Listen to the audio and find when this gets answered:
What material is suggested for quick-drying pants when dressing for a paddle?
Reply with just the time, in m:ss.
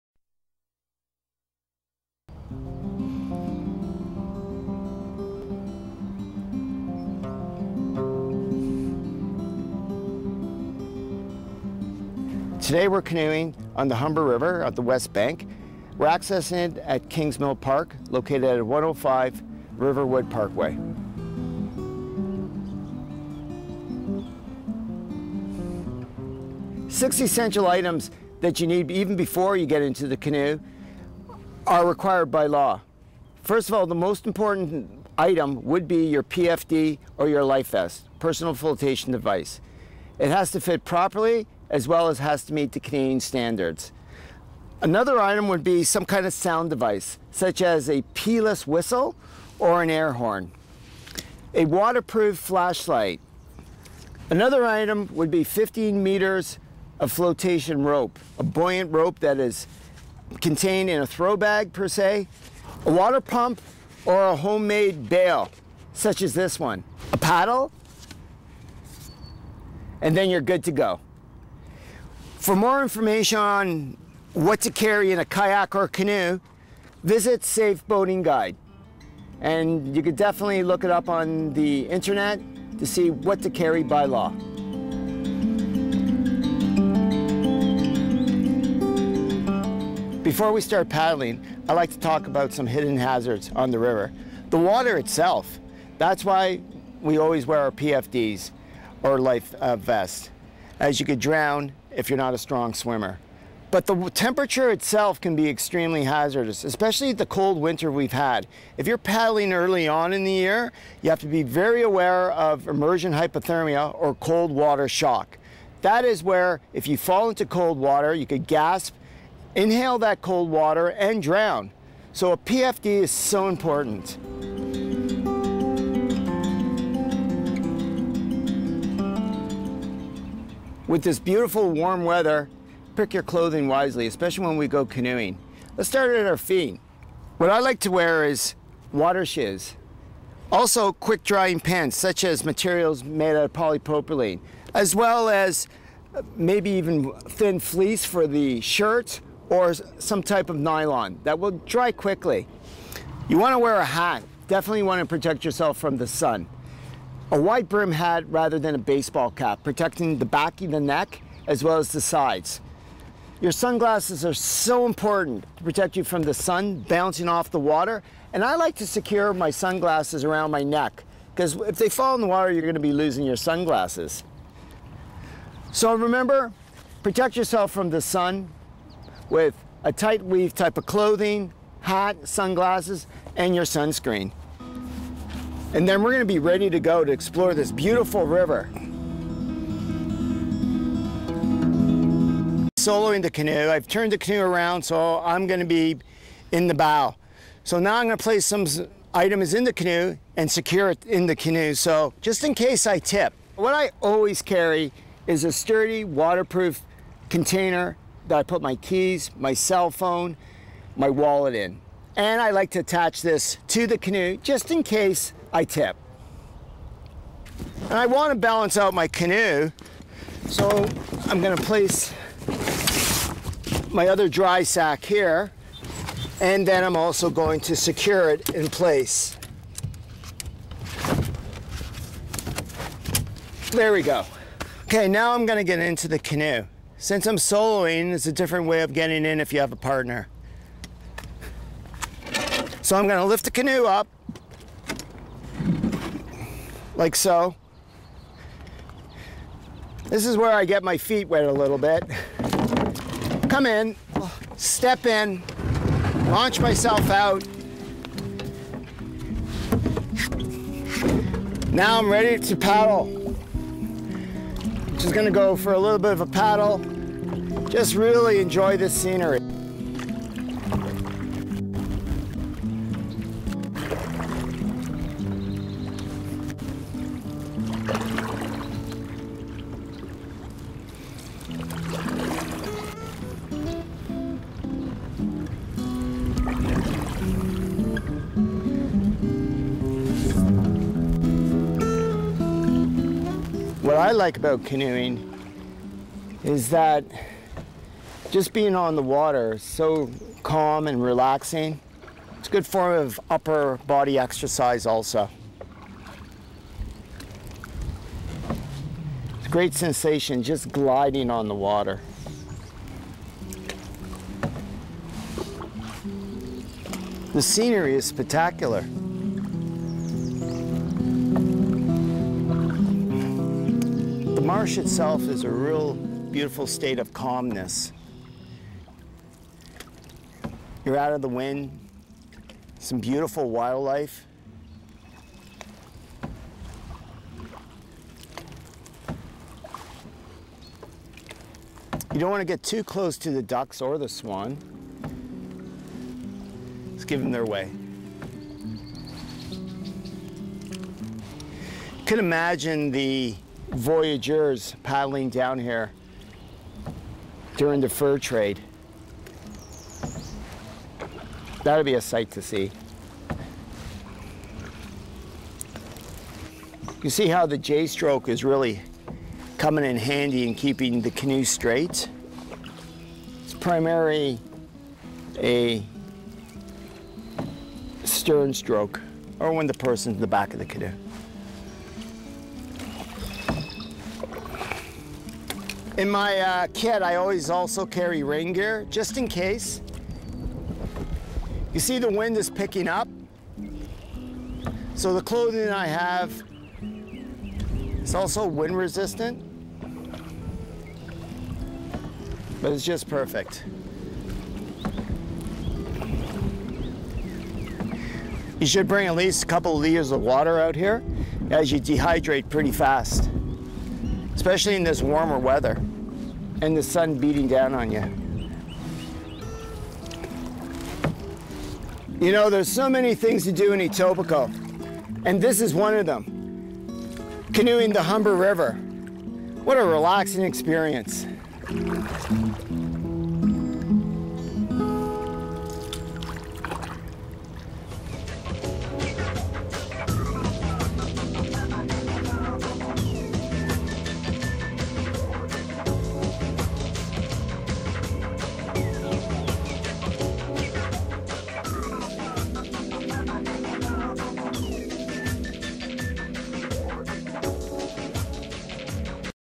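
2:23.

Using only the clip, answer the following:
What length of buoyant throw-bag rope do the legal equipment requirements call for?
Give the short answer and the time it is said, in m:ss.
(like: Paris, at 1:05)
15 meters, at 0:55.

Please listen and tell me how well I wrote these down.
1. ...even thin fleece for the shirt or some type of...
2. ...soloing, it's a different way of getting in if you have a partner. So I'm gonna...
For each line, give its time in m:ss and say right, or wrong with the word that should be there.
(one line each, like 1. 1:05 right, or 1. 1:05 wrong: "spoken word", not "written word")
1. 2:26 right
2. 3:57 right.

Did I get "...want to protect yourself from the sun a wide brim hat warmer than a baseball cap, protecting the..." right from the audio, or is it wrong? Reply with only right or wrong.
wrong.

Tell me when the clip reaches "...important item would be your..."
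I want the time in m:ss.
0:34.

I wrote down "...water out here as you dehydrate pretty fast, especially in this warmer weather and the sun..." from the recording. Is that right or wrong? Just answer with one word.
right.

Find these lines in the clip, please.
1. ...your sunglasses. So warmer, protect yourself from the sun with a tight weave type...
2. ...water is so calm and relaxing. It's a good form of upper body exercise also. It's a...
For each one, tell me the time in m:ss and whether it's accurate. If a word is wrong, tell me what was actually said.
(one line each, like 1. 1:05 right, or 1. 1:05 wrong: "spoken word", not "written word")
1. 2:53 wrong: "remember", not "warmer"
2. 4:59 right.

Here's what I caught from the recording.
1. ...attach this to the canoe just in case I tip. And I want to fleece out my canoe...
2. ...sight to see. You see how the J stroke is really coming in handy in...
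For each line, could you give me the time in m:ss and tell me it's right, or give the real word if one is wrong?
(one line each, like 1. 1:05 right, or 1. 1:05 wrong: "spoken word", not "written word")
1. 3:32 wrong: "balance", not "fleece"
2. 6:02 right.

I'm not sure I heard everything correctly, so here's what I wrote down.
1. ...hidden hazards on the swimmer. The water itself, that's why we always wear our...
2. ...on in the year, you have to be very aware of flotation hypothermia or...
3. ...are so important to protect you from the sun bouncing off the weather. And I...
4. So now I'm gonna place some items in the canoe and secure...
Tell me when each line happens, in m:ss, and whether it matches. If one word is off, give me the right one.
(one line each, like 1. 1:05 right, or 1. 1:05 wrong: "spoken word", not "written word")
1. 1:32 wrong: "river", not "swimmer"
2. 1:49 wrong: "immersion", not "flotation"
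3. 2:44 wrong: "water", not "weather"
4. 3:17 right.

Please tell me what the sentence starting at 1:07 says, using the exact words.
A paddle, and then you're good to go.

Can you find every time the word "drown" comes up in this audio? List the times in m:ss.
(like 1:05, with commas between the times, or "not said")
1:41, 2:01.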